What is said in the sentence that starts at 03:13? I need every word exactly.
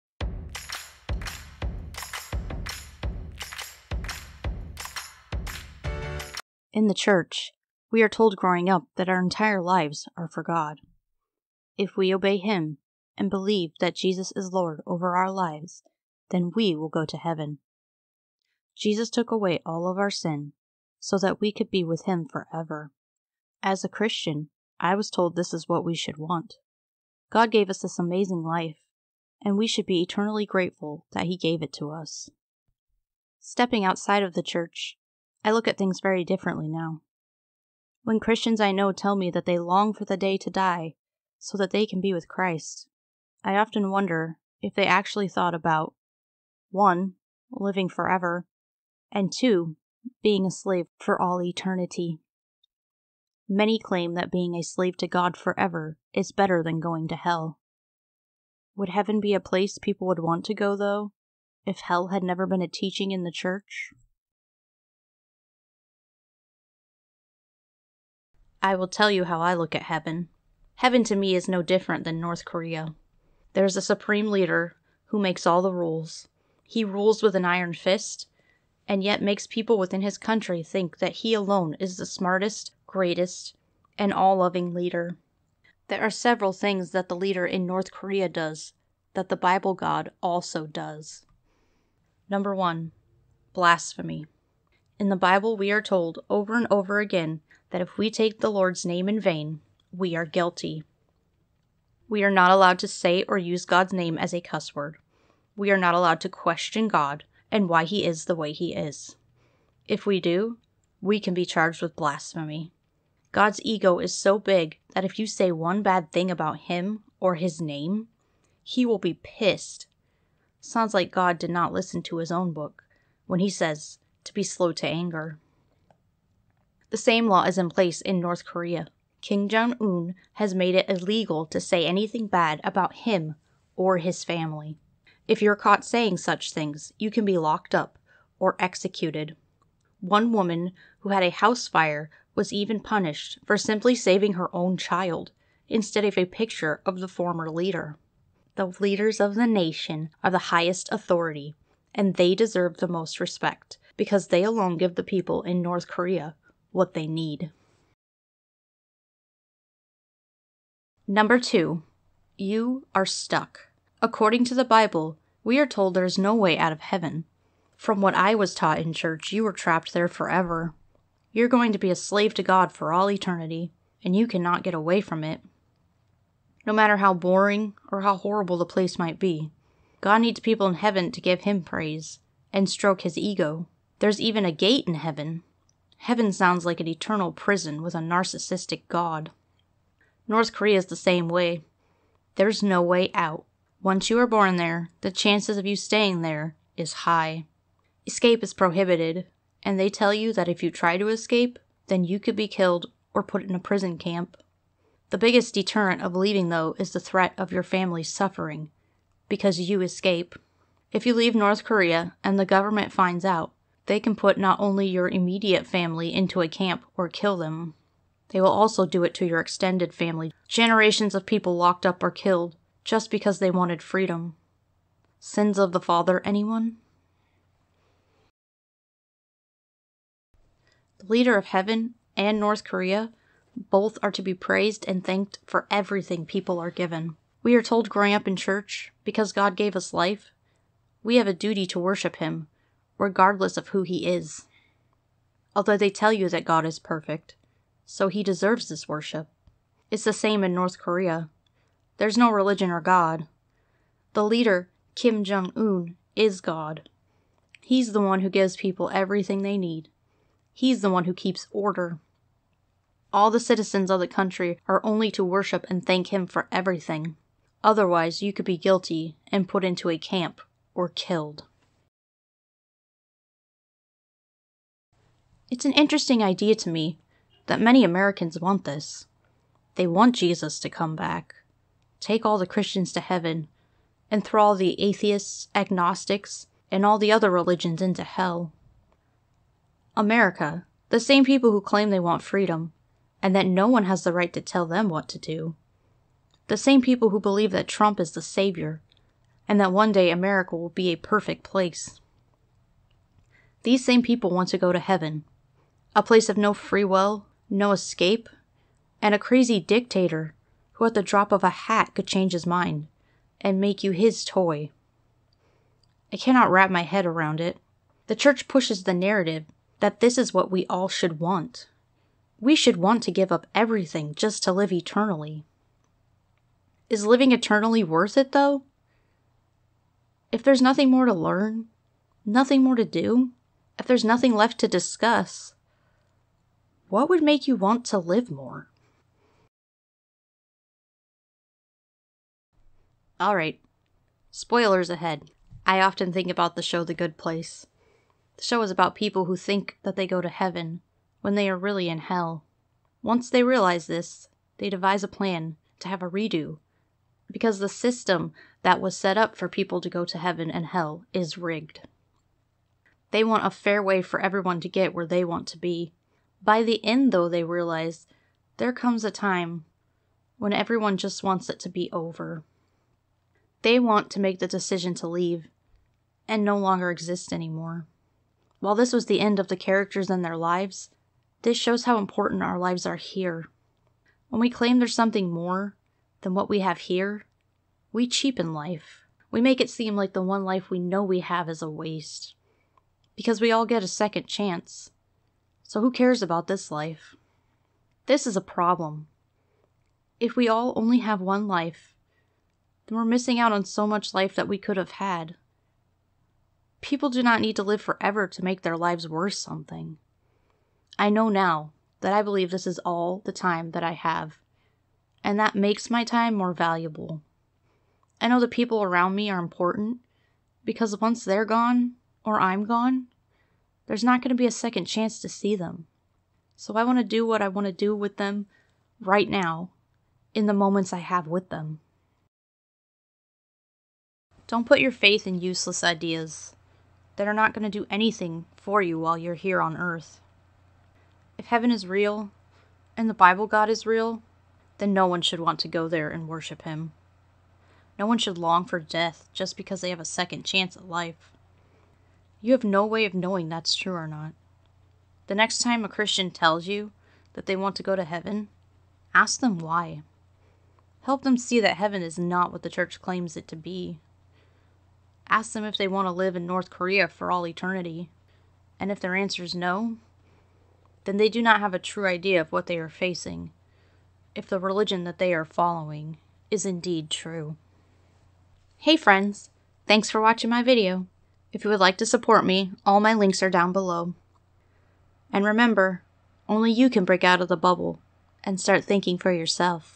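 Once you are born there, the chances of you staying there is high.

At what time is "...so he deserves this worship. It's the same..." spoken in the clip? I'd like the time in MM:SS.
04:07.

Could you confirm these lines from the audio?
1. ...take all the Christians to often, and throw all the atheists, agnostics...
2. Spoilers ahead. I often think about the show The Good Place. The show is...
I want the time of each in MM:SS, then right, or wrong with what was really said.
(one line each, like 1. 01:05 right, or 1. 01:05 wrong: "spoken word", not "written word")
1. 04:41 wrong: "heaven", not "often"
2. 05:44 right.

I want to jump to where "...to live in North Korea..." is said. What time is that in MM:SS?
07:46.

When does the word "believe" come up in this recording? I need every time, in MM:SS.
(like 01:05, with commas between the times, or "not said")
00:13, 04:57, 06:52.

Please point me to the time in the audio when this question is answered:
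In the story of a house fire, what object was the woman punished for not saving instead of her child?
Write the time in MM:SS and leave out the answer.
02:26.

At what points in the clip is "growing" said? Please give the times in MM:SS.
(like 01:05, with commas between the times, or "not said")
00:08, 03:57.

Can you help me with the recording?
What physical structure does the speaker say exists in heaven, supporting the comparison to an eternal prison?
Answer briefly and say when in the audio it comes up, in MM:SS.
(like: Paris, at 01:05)
A gate, at 03:04.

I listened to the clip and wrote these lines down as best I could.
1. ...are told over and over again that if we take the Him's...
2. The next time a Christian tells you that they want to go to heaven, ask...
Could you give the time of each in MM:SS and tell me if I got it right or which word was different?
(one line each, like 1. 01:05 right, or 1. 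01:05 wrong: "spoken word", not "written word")
1. 01:35 wrong: "Lord", not "Him"
2. 07:35 right.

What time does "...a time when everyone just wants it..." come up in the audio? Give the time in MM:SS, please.
06:09.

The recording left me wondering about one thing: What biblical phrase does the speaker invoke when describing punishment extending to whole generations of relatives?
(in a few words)
Sins of the father.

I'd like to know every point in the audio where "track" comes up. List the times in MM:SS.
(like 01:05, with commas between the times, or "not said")
not said.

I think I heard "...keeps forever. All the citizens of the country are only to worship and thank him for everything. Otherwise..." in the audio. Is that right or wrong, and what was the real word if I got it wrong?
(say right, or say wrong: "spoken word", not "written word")
wrong: "order", not "forever".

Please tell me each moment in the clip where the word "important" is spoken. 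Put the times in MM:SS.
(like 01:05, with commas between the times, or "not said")
06:21, 06:59.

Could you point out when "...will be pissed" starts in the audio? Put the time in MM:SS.
01:58.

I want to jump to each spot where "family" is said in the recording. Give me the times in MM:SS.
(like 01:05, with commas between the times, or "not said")
02:14, 03:27, 03:35, 03:39.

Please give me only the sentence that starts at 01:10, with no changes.
Heaven to me is no different than North Korea.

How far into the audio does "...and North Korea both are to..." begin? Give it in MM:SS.
03:52.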